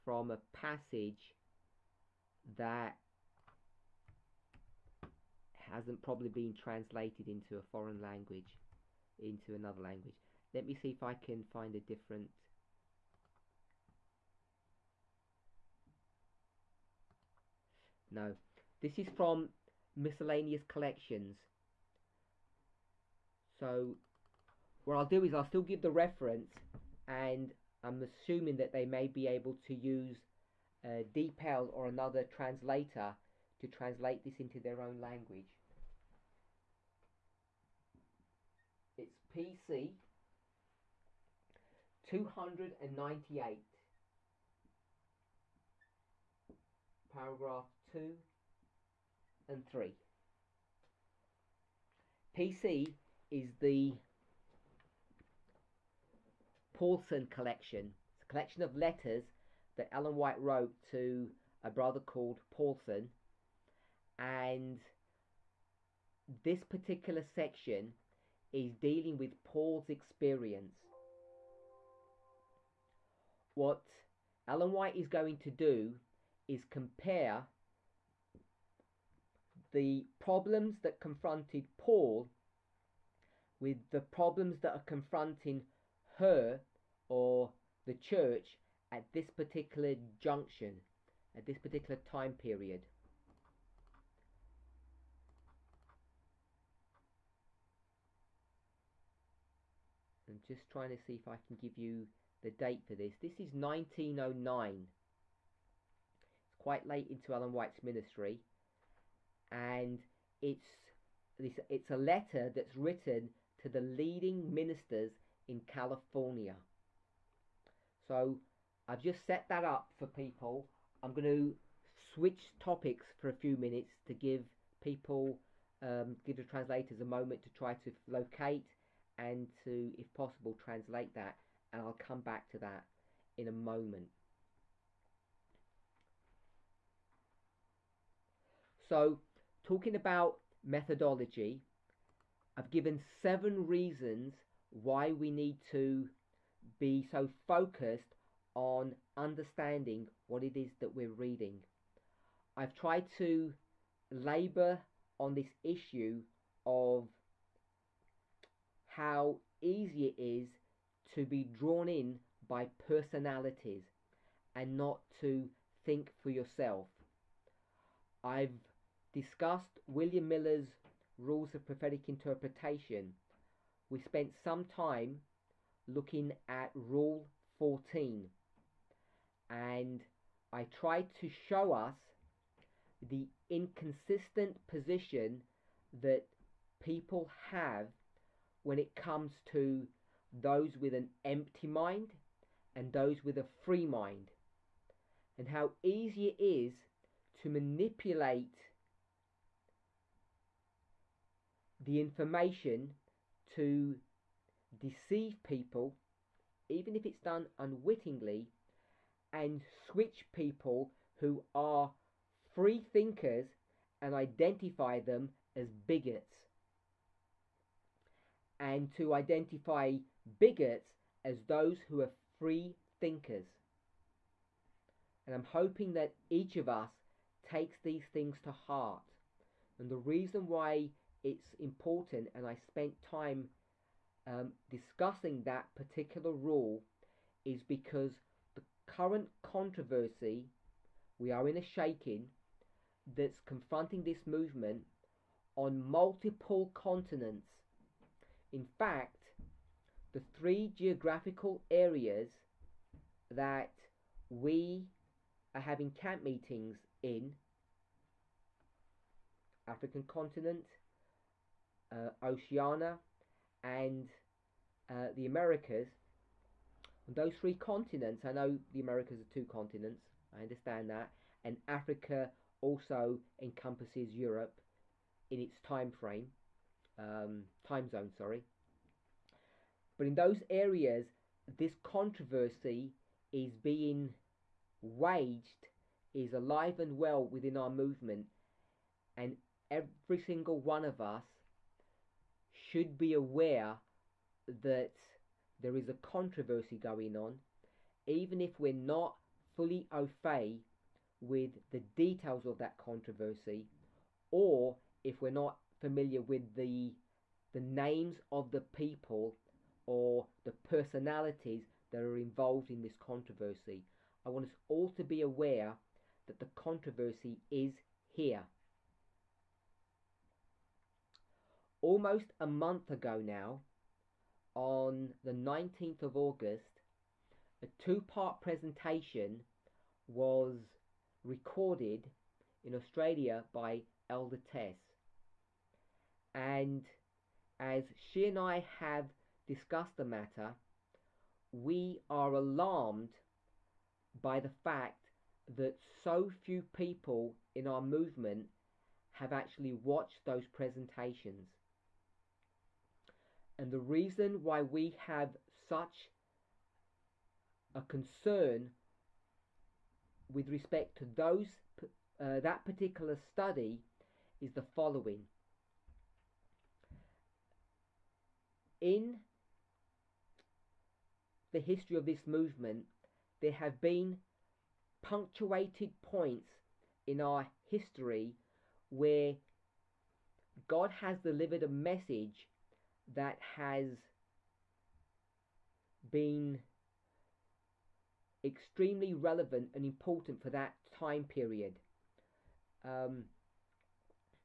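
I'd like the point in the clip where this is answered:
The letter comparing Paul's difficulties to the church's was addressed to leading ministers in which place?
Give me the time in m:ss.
1:55.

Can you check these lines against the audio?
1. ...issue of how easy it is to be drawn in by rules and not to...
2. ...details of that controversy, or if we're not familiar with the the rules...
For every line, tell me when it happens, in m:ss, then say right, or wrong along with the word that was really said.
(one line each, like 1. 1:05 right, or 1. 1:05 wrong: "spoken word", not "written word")
1. 2:35 wrong: "personalities", not "rules"
2. 5:01 wrong: "names", not "rules".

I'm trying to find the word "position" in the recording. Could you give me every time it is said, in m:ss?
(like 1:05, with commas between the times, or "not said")
3:04.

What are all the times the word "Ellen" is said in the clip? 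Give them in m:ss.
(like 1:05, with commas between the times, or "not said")
0:59, 1:14, 1:47.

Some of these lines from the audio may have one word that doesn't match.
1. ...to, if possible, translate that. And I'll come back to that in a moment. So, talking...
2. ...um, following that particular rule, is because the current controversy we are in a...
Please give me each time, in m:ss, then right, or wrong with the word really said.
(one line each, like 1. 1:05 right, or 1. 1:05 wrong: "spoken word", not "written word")
1. 2:09 right
2. 3:54 wrong: "discussing", not "following".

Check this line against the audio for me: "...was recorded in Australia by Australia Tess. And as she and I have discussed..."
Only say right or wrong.
wrong.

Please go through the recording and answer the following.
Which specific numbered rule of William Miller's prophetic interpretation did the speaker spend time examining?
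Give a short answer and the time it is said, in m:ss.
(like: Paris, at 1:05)
Rule 14, at 2:56.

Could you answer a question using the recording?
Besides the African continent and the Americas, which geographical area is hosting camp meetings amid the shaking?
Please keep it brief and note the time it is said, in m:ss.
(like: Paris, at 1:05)
Oceania, at 4:22.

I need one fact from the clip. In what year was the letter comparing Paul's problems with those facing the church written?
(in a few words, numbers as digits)
1909.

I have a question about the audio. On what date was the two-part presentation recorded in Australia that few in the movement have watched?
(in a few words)
19 August.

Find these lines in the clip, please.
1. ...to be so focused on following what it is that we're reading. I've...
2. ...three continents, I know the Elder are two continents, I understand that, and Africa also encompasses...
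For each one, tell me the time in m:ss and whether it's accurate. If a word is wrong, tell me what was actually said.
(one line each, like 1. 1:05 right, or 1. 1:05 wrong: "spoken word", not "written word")
1. 2:25 wrong: "understanding", not "following"
2. 4:27 wrong: "Americas", not "Elder".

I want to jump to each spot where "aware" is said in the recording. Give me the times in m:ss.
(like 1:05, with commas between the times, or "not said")
4:53, 5:15.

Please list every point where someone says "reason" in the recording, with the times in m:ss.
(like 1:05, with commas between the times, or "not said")
2:23, 3:49, 5:53.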